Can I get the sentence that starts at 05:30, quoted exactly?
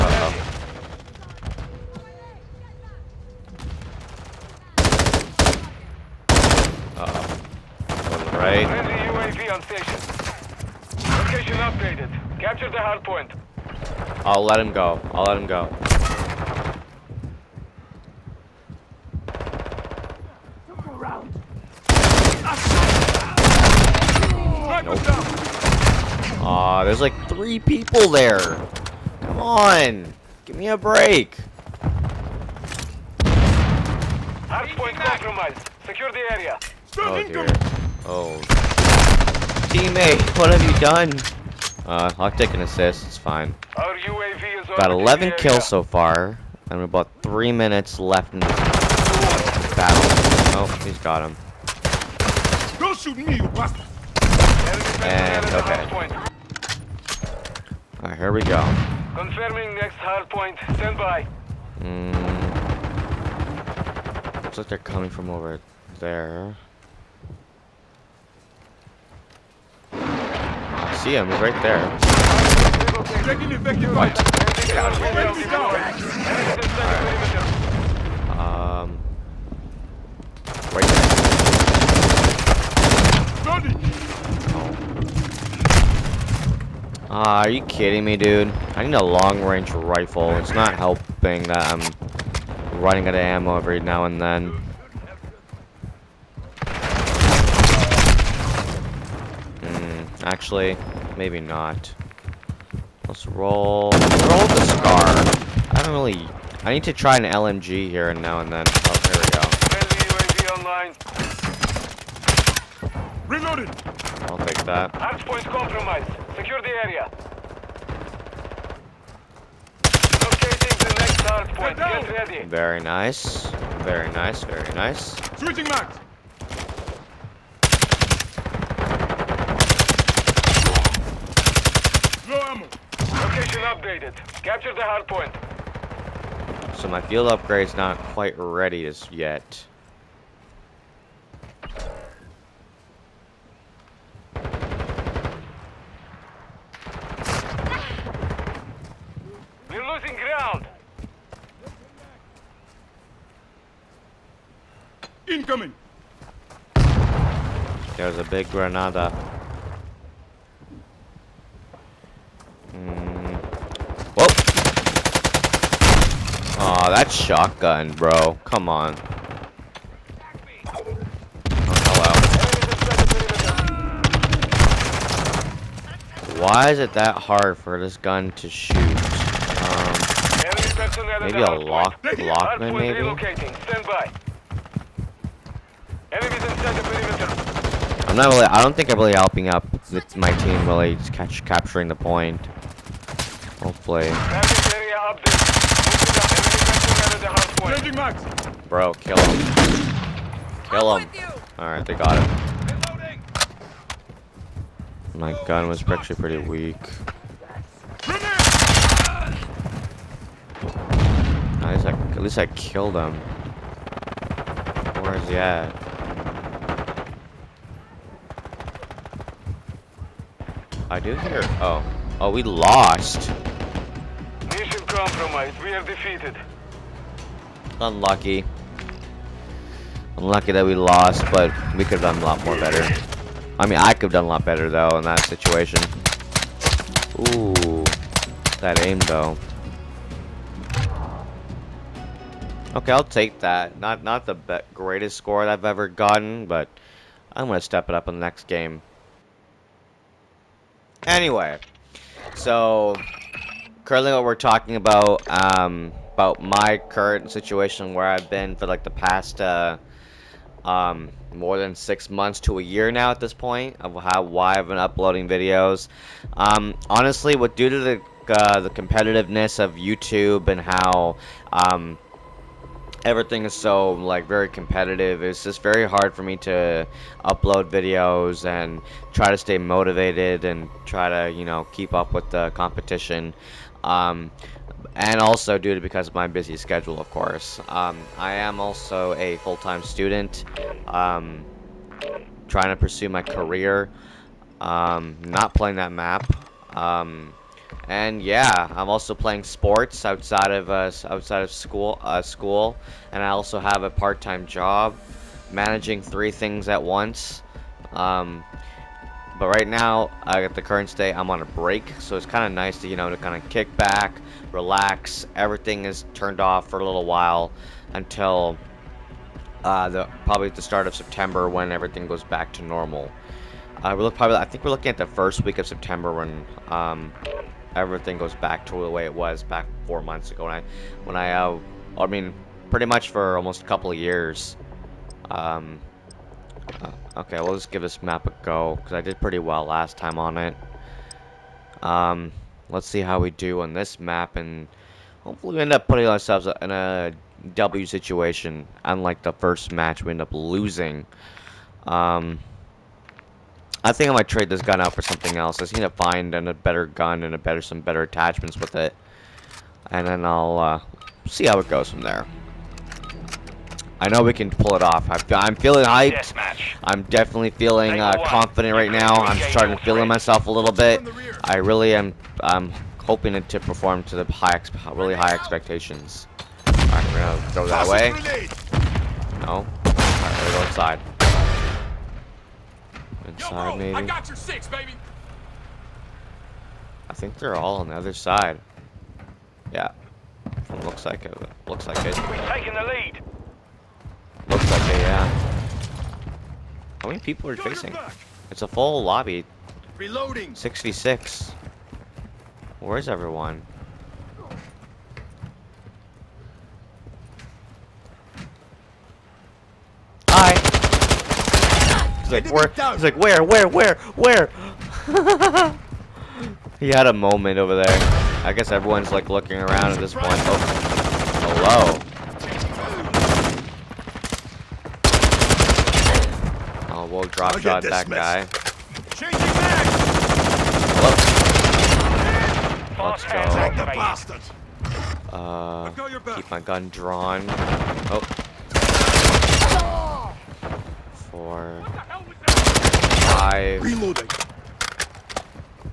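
When I, when I, uh, I mean, pretty much for almost a couple of years.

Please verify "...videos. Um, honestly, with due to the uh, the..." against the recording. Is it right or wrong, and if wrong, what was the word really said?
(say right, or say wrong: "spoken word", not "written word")
right.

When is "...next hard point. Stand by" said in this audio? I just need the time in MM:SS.
00:59.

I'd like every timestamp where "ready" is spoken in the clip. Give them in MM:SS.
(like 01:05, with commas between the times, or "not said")
02:02, 02:18.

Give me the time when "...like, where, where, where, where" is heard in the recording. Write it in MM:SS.
06:53.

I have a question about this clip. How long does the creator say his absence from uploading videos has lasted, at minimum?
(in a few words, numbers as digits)
more than six months.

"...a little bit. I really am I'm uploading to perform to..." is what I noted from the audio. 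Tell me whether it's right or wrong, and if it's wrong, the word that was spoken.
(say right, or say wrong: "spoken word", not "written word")
wrong: "hoping", not "uploading".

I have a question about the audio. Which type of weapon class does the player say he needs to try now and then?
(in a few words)
LMG.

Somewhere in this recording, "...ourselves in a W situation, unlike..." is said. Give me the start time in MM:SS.
05:46.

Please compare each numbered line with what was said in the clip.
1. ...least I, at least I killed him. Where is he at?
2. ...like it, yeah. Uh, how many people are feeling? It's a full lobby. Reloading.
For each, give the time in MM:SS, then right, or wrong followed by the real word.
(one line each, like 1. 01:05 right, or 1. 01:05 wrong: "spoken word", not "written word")
1. 03:31 right
2. 06:34 wrong: "facing", not "feeling".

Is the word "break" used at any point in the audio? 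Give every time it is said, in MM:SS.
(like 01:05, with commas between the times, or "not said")
00:30, 05:11.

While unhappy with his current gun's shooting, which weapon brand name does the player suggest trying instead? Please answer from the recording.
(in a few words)
Lachmann.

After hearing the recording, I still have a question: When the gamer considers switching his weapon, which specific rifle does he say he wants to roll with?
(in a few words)
SCAR.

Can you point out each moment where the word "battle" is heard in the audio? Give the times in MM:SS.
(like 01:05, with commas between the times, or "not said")
00:49.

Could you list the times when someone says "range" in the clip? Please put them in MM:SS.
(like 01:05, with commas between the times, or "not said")
01:29.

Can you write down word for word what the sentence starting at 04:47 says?
Um, I am also a full-time student, um, trying to pursue my career, um, not playing that map.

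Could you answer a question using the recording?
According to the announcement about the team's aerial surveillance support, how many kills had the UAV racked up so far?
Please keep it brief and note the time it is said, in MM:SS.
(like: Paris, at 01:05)
11, at 00:44.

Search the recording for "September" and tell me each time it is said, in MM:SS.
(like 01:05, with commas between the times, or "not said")
05:20, 05:25.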